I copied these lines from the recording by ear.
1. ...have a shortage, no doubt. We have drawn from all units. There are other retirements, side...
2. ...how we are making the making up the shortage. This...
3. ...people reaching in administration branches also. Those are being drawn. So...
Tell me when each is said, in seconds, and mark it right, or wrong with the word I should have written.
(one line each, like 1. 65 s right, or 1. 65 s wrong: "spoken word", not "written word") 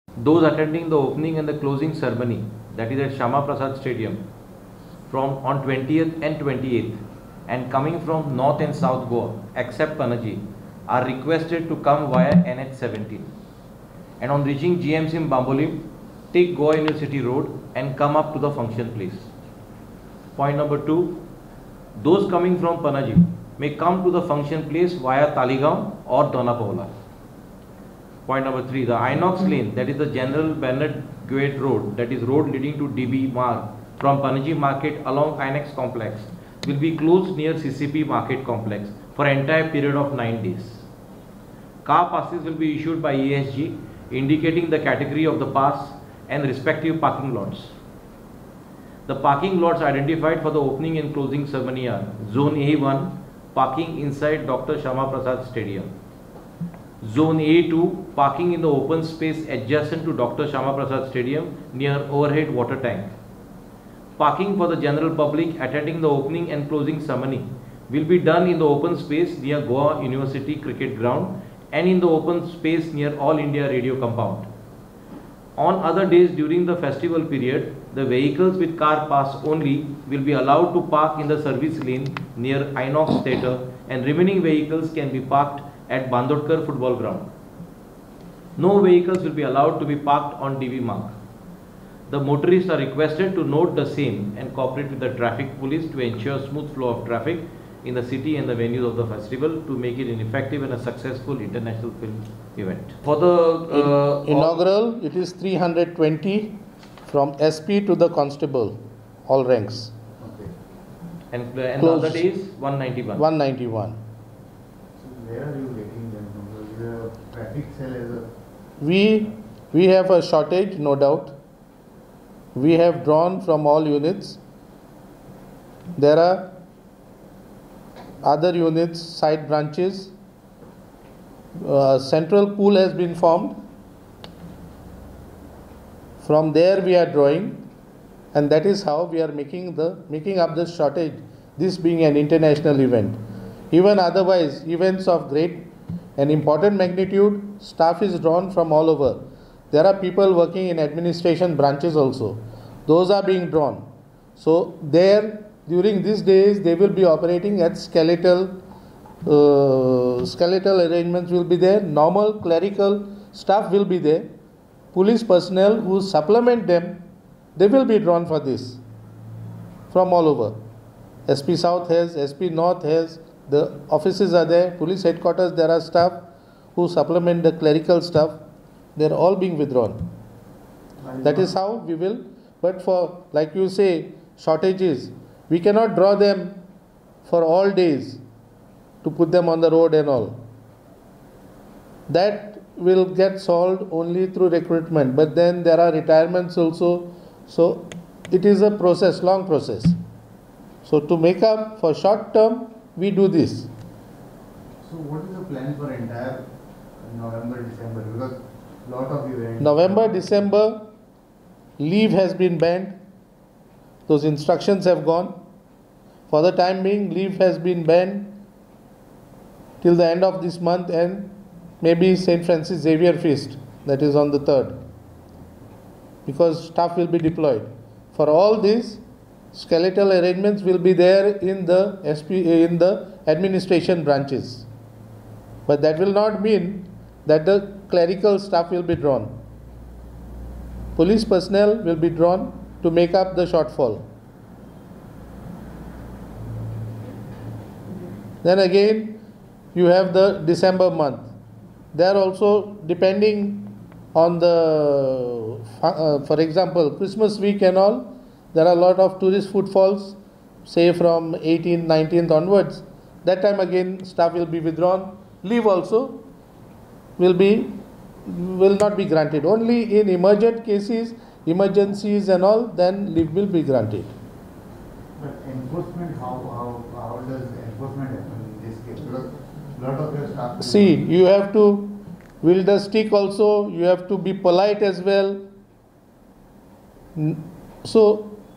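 1. 119 s wrong: "units", not "retirements"
2. 138 s right
3. 149 s wrong: "working", not "reaching".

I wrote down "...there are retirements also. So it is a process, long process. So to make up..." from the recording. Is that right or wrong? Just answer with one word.
right.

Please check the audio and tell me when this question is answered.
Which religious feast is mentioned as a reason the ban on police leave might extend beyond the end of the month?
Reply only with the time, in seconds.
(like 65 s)
222 s.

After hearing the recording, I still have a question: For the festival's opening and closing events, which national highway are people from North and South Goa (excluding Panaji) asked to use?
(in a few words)
NH17.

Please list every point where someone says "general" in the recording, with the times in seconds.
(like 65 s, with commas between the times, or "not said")
30 s, 64 s.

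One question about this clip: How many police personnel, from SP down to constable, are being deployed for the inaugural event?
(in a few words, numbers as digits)
320.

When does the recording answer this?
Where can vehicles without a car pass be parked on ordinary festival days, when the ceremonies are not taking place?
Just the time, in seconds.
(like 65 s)
86 s.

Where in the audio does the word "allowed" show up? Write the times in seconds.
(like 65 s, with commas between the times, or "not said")
80 s, 89 s.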